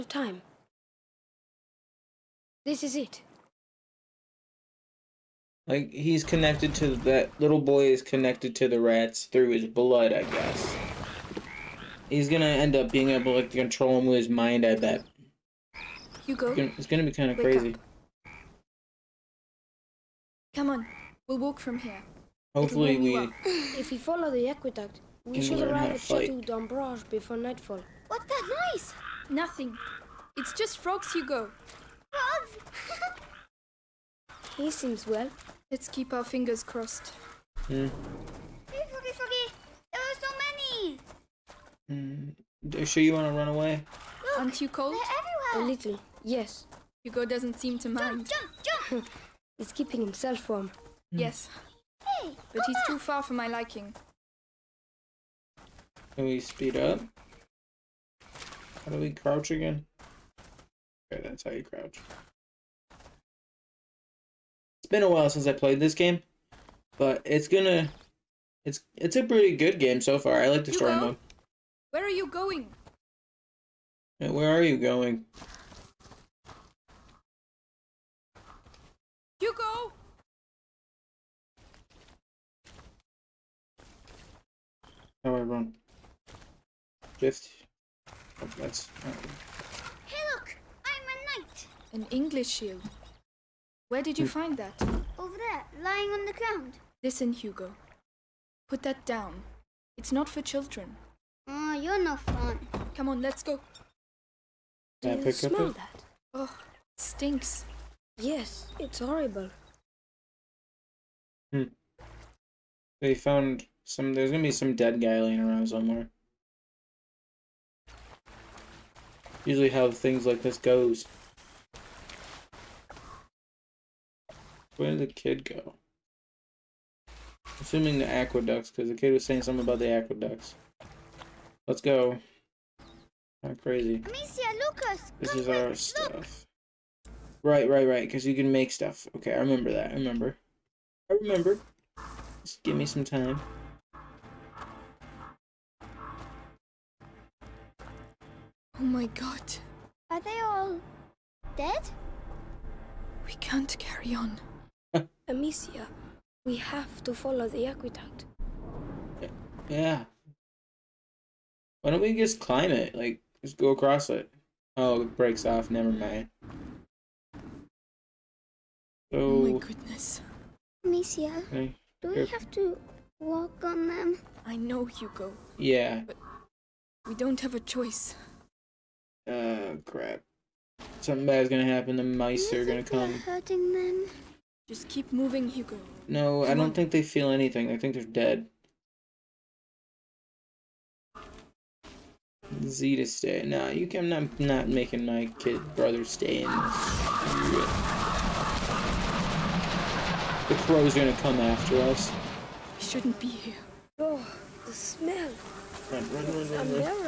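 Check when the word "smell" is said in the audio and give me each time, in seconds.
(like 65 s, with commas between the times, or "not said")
105 s, 204 s.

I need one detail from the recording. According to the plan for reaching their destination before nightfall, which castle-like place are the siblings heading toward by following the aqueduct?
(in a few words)
Chateau d'Ombrage.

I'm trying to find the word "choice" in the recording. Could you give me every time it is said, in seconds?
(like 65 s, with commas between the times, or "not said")
177 s.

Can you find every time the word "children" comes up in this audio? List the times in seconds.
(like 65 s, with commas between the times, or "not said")
100 s.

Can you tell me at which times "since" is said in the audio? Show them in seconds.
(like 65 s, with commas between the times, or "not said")
65 s.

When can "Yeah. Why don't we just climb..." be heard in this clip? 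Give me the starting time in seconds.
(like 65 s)
159 s.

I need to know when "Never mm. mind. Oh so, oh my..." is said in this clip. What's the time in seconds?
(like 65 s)
165 s.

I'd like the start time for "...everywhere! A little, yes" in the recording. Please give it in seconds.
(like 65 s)
45 s.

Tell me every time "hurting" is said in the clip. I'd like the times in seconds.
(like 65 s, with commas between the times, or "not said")
183 s.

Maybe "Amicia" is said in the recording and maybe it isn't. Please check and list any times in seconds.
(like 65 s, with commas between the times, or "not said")
133 s, 155 s, 170 s.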